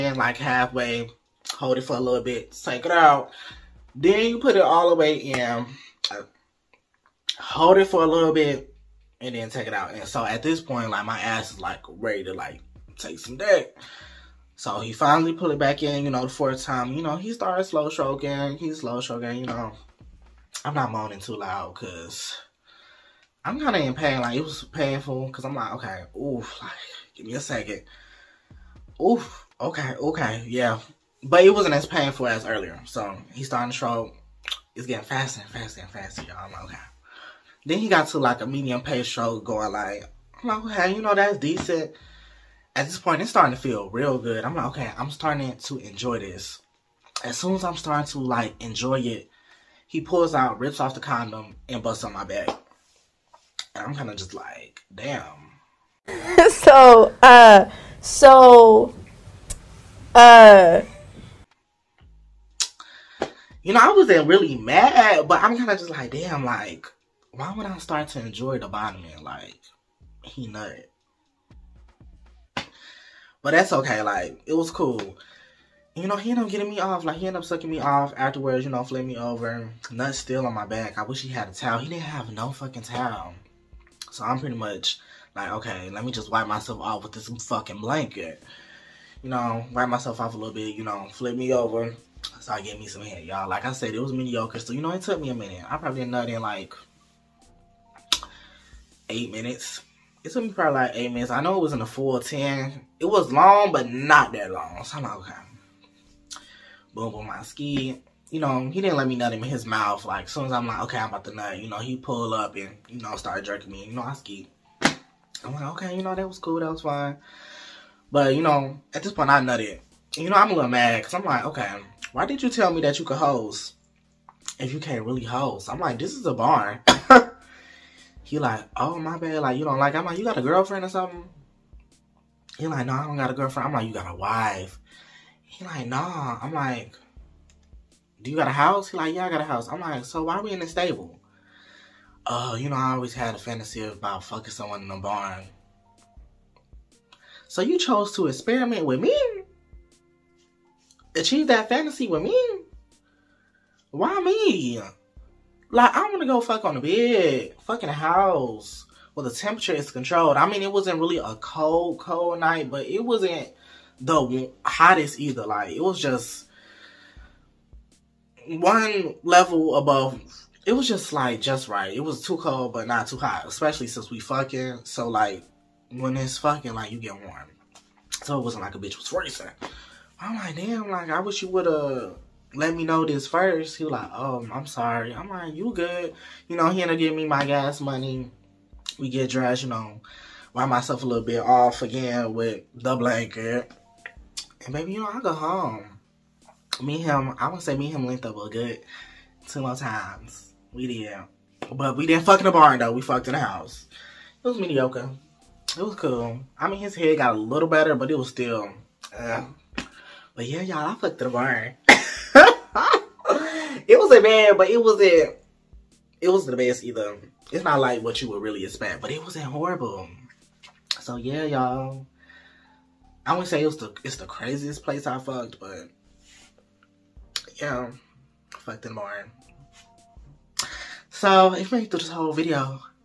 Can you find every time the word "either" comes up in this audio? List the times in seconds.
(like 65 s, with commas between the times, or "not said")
165 s, 216 s.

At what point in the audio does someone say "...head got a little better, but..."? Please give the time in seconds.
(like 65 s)
206 s.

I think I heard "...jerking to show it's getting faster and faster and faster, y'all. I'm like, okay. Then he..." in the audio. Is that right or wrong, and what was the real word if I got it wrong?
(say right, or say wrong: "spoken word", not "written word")
wrong: "starting", not "jerking".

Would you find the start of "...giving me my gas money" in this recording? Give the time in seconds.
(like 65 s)
186 s.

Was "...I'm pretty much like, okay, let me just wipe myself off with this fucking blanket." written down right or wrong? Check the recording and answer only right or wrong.
right.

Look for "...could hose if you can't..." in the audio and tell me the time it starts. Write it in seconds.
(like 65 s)
123 s.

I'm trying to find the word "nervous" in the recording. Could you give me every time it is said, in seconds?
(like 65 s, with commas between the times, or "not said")
not said.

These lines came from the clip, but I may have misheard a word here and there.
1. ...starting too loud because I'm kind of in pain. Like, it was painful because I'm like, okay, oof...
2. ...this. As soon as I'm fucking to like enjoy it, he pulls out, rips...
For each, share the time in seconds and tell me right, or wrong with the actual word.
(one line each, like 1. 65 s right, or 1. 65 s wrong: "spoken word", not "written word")
1. 20 s wrong: "moaning", not "starting"
2. 46 s wrong: "starting", not "fucking".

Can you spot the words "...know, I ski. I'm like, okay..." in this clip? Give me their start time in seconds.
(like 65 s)
113 s.